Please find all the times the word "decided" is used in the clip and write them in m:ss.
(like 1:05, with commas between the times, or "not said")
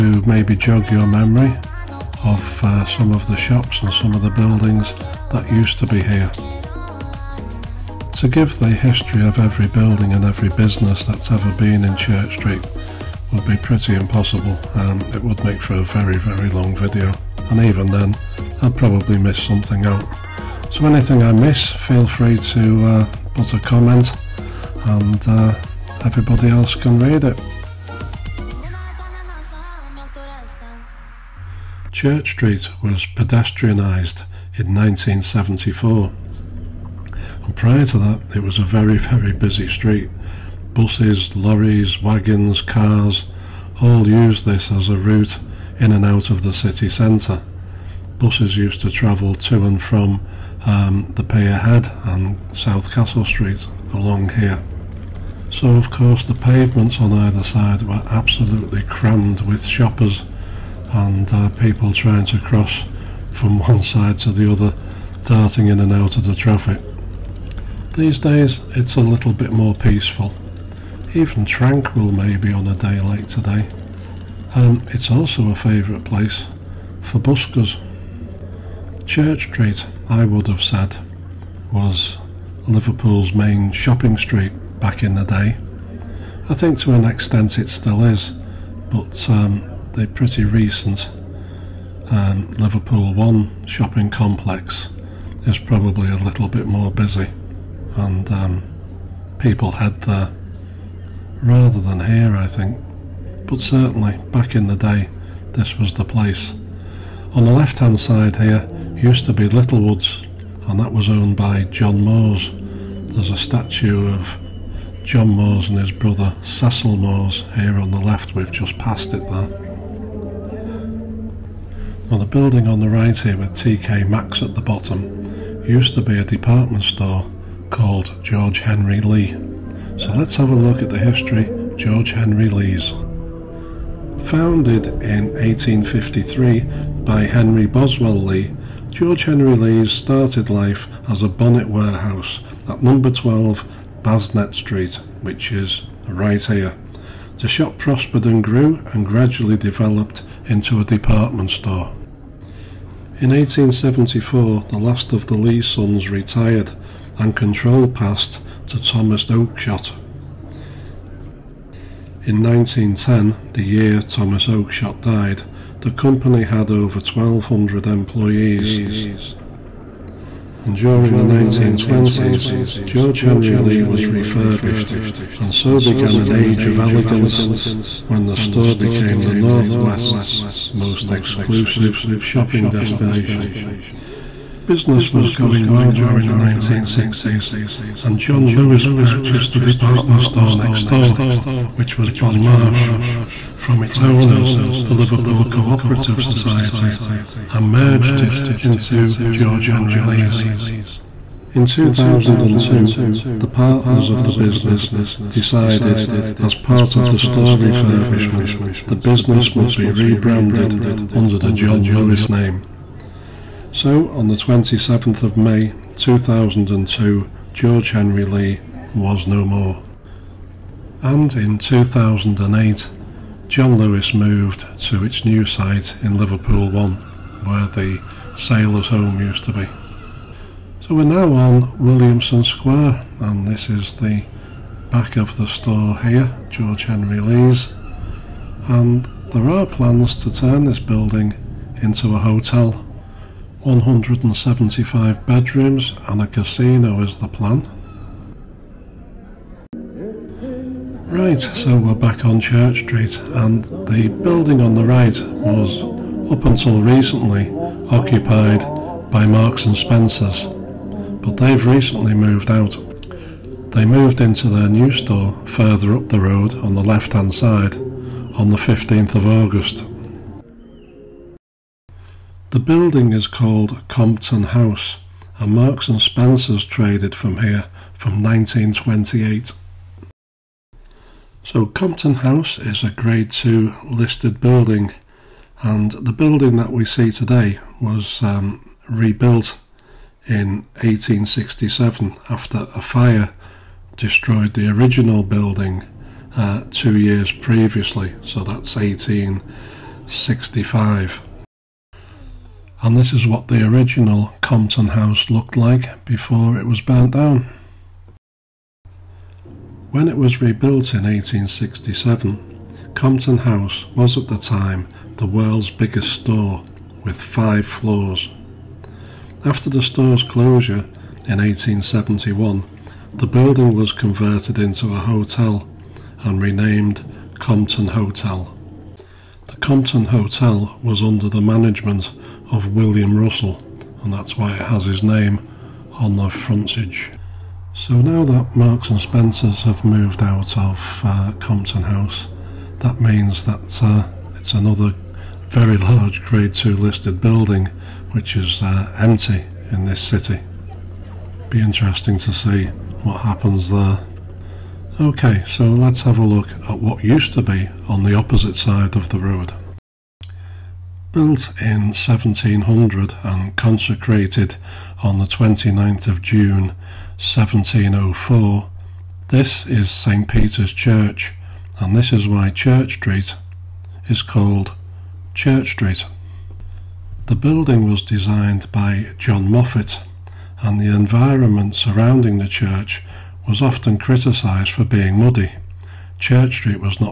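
3:25.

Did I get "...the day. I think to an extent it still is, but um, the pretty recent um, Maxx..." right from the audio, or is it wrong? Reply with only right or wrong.
wrong.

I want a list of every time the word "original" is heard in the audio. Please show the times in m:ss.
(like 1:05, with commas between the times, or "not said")
4:54, 5:03.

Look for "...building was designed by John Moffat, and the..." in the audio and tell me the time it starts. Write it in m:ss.
6:17.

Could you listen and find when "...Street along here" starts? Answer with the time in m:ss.
0:53.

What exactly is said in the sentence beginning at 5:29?
The Compton Hotel was under the management of William Russell, and that's why it has his name on the frontage.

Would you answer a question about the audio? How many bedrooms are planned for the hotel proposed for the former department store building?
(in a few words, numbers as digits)
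175.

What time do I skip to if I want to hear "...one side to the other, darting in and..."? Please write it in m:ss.
1:03.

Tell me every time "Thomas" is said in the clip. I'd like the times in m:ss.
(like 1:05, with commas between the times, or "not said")
2:38, 2:44.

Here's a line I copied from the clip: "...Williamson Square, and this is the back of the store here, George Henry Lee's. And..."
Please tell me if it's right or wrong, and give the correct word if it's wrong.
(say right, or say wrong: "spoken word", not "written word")
right.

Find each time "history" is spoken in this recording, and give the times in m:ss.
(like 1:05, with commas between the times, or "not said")
0:08, 2:10.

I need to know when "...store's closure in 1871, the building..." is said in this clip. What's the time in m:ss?
5:19.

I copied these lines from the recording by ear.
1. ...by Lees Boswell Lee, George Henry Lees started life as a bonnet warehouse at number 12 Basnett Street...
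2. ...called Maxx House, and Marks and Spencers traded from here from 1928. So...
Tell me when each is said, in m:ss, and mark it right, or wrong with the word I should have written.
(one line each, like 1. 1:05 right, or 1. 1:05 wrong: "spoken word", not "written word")
1. 2:17 wrong: "Henry", not "Lees"
2. 4:33 wrong: "Compton", not "Maxx".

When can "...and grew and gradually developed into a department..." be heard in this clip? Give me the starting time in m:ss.
2:28.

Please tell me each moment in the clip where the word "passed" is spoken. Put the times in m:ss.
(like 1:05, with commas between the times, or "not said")
1:58, 2:37.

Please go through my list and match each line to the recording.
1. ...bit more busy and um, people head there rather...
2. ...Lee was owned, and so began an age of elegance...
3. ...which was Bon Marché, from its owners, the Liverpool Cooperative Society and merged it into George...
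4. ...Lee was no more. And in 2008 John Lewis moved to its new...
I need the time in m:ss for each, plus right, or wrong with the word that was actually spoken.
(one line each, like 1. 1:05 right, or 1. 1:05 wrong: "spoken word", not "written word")
1. 1:36 right
2. 2:53 wrong: "refurbished", not "owned"
3. 3:11 right
4. 3:38 right.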